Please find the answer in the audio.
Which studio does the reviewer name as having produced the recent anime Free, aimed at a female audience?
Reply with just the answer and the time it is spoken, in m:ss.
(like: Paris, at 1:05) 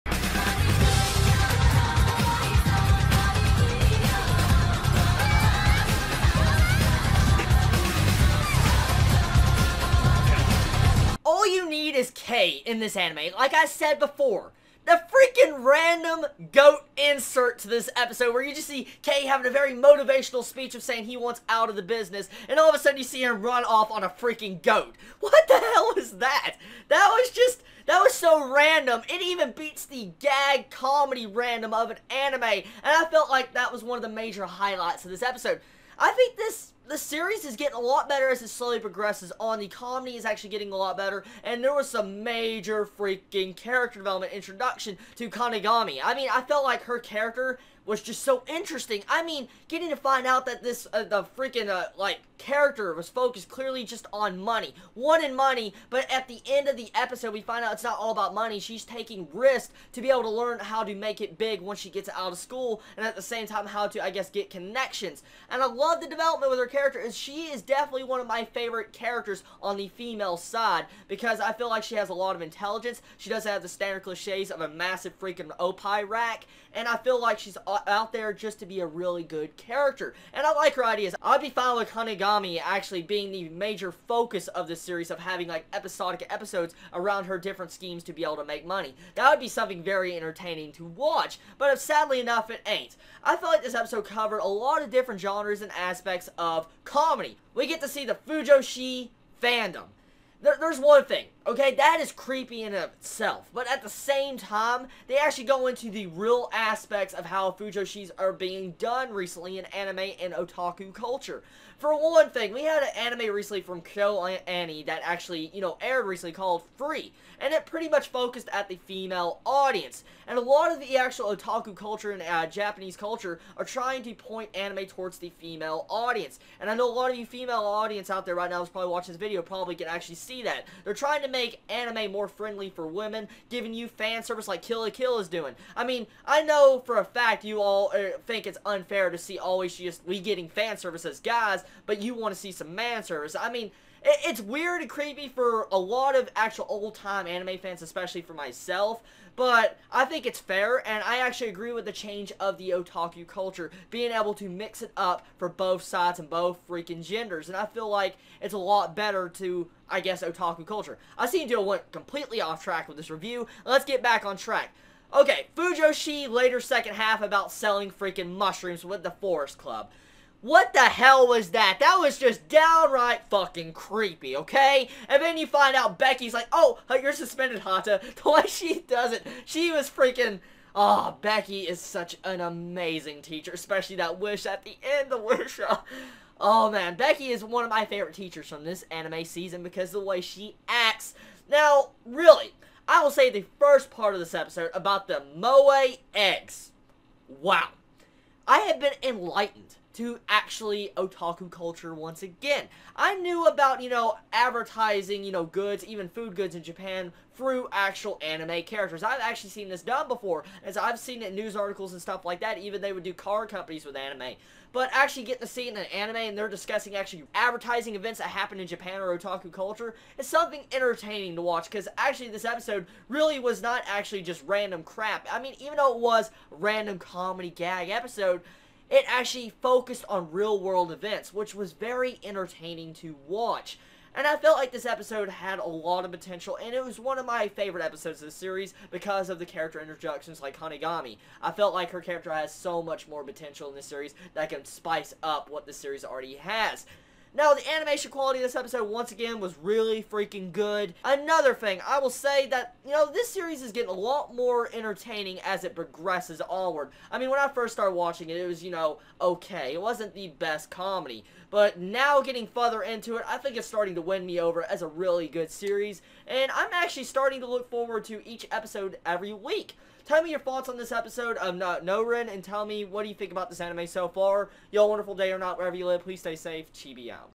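KyoAni, at 1:53.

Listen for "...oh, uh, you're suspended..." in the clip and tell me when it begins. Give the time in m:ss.
2:56.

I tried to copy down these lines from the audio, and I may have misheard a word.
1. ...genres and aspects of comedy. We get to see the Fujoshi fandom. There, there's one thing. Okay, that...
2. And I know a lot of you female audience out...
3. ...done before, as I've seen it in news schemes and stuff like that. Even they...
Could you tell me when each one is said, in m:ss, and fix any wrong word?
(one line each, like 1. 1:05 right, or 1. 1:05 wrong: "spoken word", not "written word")
1. 1:35 right
2. 2:06 right
3. 3:29 wrong: "articles", not "schemes".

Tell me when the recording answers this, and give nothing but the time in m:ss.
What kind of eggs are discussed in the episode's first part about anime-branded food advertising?
3:15.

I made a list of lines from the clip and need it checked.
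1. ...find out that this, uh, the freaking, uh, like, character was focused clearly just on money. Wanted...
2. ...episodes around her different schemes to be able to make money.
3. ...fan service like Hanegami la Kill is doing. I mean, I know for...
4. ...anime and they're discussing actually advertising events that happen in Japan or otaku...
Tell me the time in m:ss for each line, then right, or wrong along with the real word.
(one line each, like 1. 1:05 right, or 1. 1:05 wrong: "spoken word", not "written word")
1. 0:49 right
2. 1:26 right
3. 2:13 wrong: "Kill", not "Hanegami"
4. 3:35 right.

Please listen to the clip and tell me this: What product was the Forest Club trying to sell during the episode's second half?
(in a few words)
Mushrooms.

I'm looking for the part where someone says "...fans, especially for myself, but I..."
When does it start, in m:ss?
2:27.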